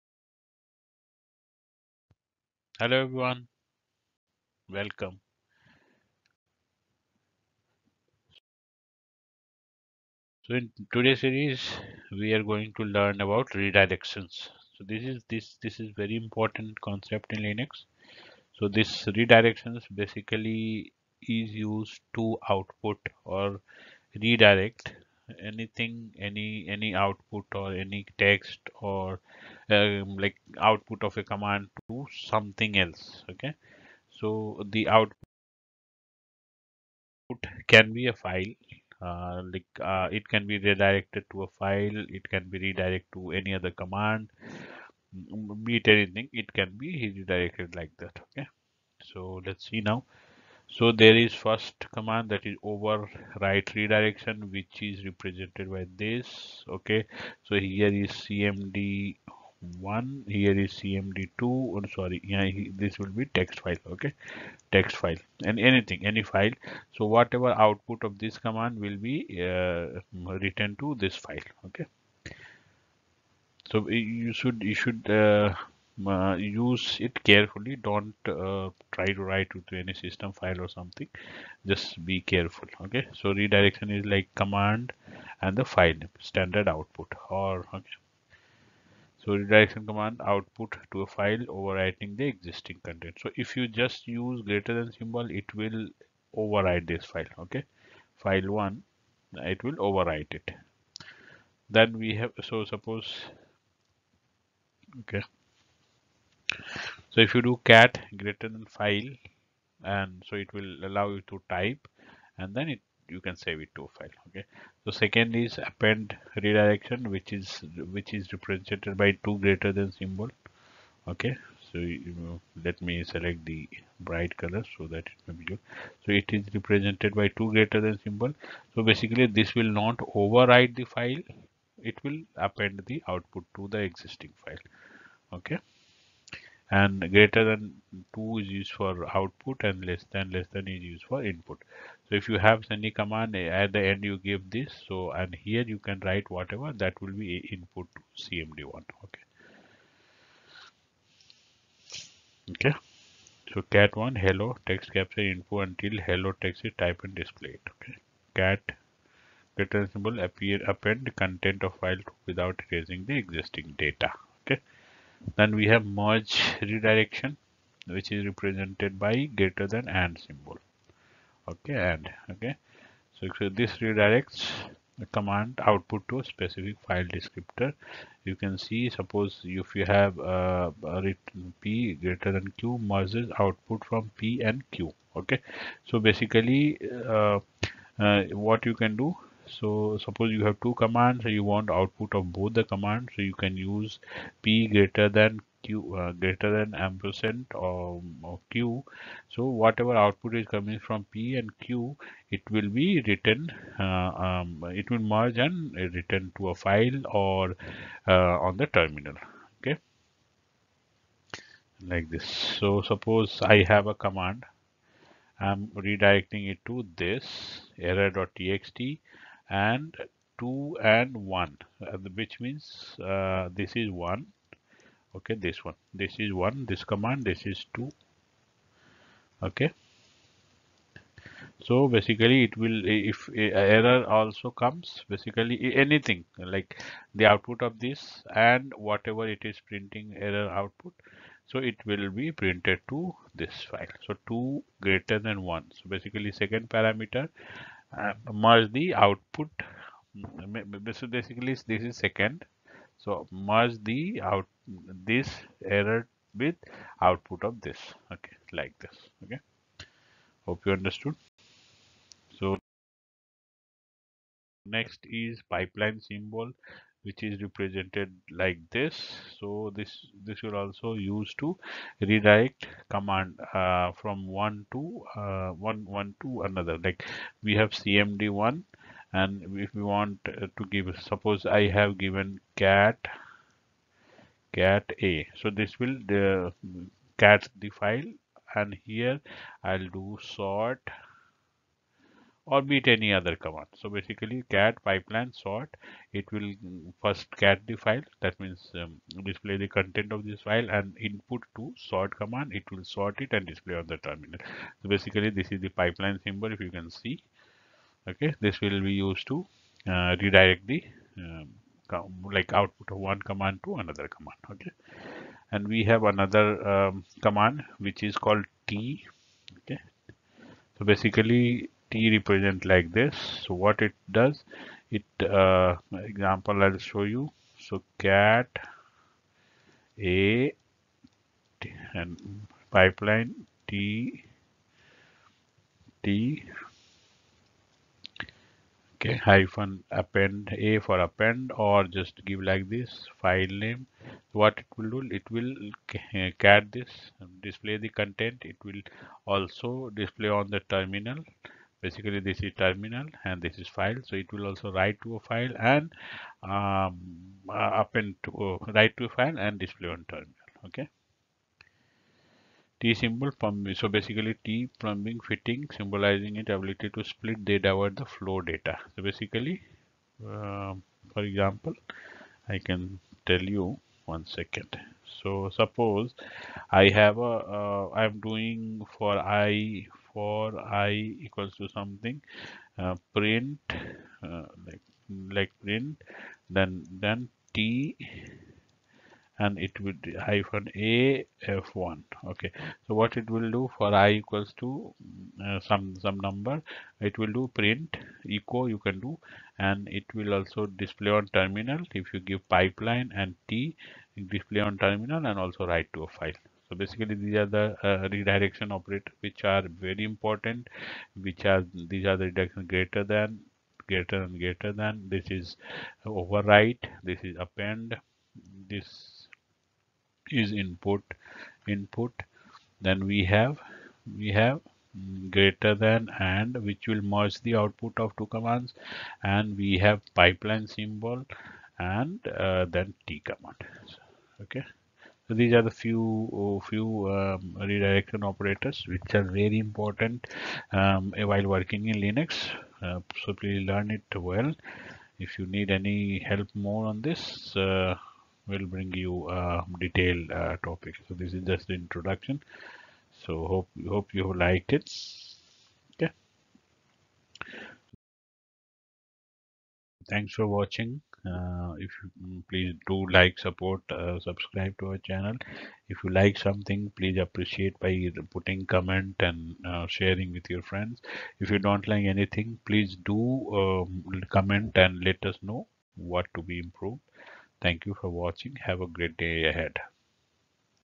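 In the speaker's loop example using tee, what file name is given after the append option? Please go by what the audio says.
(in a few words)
f1.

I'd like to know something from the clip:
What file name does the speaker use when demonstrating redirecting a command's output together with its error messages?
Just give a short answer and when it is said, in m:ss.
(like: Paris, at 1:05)
error.txt, at 3:37.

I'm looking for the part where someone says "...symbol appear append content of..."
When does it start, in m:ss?
2:39.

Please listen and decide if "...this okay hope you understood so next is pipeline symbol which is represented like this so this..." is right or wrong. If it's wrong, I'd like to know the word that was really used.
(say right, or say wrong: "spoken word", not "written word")
right.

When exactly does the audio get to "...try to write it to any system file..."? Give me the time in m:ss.
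1:18.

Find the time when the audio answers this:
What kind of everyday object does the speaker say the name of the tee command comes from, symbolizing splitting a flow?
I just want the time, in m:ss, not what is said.
6:04.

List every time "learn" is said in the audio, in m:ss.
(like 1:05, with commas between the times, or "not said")
0:12, 7:23.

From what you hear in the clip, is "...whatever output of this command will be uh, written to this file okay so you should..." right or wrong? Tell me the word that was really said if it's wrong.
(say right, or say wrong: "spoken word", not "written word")
right.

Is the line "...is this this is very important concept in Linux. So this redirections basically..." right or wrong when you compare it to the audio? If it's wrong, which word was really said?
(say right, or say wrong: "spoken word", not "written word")
right.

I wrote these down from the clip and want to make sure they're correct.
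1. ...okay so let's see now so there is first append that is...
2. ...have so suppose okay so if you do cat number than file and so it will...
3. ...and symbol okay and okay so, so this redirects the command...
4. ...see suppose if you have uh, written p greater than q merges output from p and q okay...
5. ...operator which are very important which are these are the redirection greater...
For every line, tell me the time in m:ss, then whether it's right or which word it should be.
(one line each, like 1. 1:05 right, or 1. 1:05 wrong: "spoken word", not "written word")
1. 0:48 wrong: "command", not "append"
2. 1:42 wrong: "greater", not "number"
3. 2:49 right
4. 2:58 right
5. 6:48 right.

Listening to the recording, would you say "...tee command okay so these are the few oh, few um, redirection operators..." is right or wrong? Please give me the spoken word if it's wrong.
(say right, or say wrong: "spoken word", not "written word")
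right.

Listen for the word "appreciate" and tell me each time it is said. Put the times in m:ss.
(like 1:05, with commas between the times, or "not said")
7:47.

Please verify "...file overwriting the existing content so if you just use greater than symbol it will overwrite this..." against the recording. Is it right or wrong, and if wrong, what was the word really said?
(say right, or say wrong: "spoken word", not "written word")
right.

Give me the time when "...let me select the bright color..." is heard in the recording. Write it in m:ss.
2:02.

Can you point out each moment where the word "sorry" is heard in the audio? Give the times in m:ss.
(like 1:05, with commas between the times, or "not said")
1:01.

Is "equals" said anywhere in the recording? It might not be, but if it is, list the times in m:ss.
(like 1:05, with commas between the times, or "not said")
6:21, 6:34.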